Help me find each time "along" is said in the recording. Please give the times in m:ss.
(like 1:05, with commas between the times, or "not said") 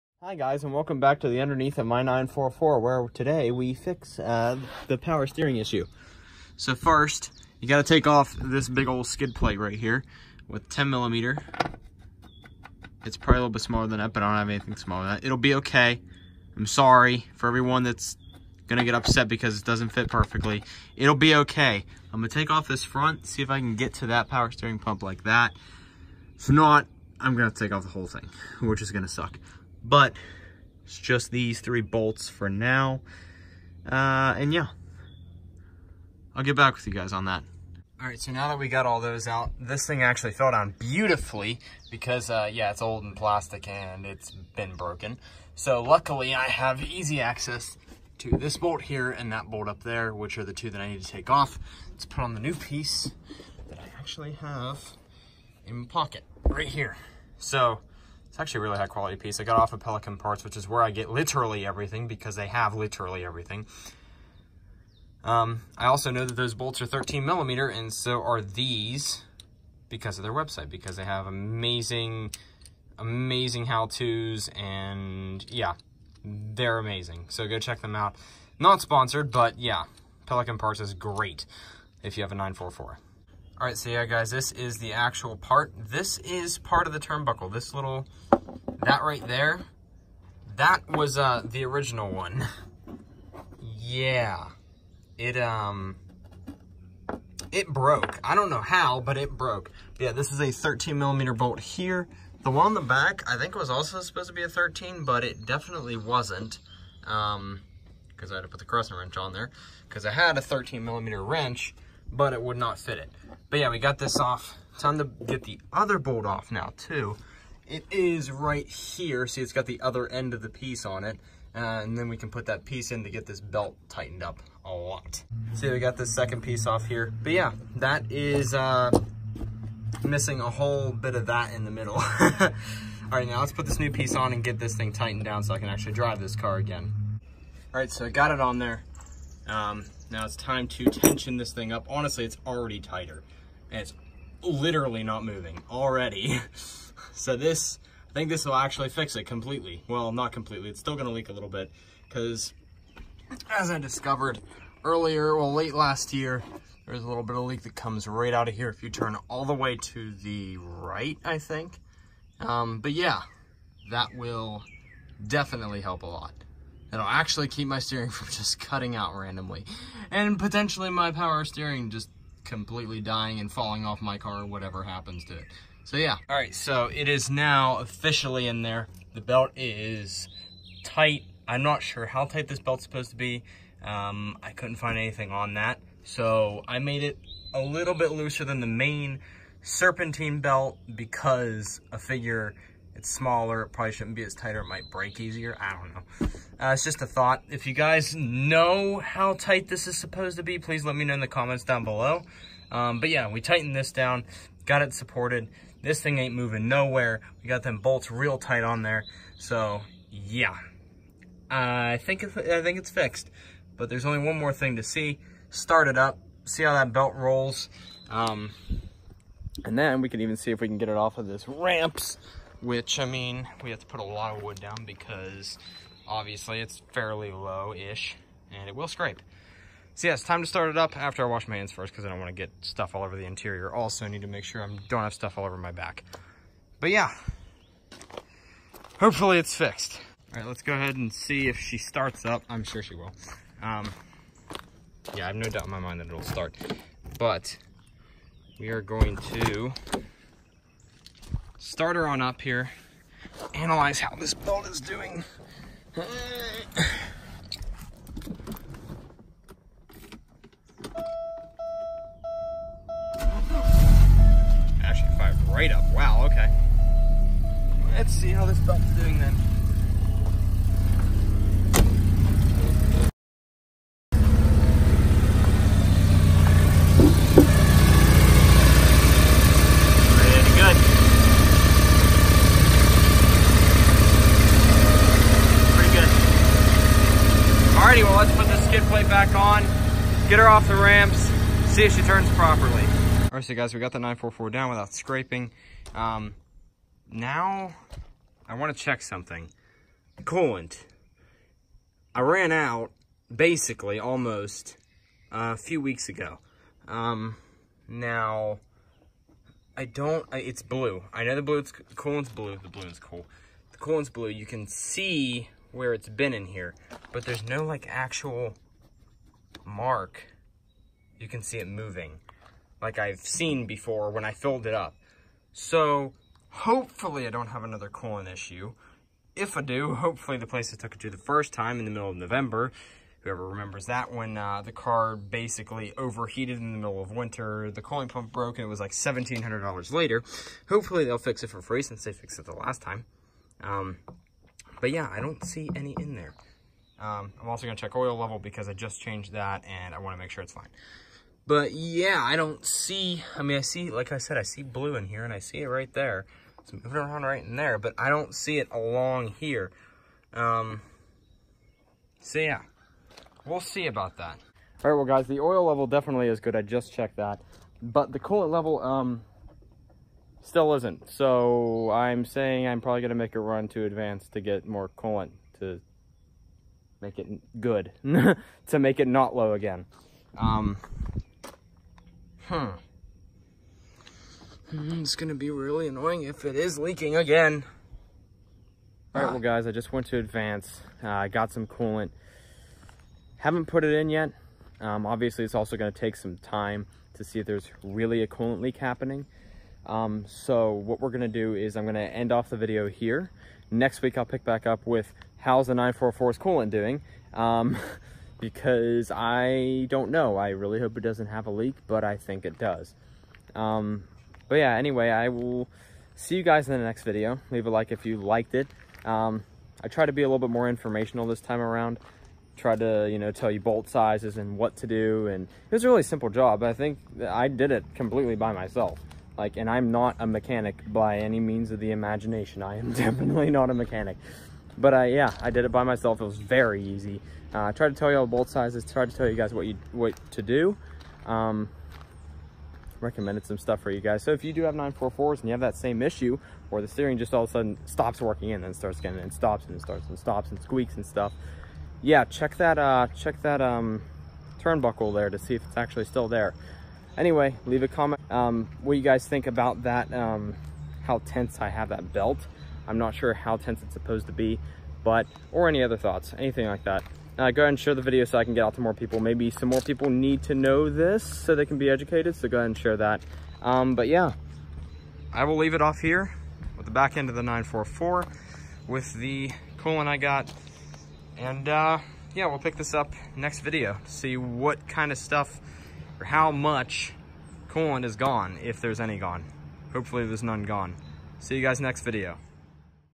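5:58.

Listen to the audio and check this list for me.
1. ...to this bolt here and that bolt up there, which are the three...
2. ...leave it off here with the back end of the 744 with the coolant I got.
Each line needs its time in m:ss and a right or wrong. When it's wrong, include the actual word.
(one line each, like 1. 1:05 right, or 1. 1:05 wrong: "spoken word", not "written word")
1. 0:48 wrong: "two", not "three"
2. 7:55 wrong: "944", not "744".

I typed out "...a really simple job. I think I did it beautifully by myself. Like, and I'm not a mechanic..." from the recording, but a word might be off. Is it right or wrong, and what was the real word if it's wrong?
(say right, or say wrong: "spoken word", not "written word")
wrong: "completely", not "beautifully".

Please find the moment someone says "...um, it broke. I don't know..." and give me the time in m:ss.
1:35.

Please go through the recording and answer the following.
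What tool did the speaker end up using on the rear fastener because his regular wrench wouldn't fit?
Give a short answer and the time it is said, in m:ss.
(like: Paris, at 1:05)
crescent wrench, at 1:48.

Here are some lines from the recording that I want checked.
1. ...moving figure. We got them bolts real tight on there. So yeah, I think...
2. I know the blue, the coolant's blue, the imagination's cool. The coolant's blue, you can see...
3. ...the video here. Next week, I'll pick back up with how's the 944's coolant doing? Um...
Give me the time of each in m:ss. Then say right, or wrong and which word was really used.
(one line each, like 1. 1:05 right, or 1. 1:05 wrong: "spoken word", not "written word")
1. 3:26 wrong: "nowhere", not "figure"
2. 5:11 wrong: "balloon", not "imagination"
3. 6:42 right.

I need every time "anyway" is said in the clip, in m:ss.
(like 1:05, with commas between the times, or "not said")
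6:54, 7:37.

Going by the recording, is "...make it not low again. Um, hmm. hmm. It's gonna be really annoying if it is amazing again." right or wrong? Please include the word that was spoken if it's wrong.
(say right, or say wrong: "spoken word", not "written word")
wrong: "leaking", not "amazing".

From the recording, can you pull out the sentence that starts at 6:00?
Um, so yeah, we'll see about that.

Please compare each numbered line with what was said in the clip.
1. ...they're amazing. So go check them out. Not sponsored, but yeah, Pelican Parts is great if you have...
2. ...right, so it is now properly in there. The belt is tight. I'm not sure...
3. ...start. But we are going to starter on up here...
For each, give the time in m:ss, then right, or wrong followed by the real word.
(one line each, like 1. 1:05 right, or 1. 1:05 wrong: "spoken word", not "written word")
1. 1:16 right
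2. 2:56 wrong: "officially", not "properly"
3. 4:06 right.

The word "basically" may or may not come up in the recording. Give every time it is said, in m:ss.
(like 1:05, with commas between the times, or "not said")
5:03, 5:35.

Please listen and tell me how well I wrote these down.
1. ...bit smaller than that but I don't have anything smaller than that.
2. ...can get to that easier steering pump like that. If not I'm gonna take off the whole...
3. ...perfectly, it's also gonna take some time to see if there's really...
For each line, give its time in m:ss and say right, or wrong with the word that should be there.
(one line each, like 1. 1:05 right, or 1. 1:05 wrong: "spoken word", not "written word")
1. 0:13 right
2. 0:23 wrong: "power", not "easier"
3. 6:35 wrong: "obviously", not "perfectly".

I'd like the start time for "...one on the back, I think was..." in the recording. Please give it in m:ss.
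1:42.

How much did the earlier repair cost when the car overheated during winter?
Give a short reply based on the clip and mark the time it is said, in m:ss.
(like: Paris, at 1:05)
$1,700, at 5:38.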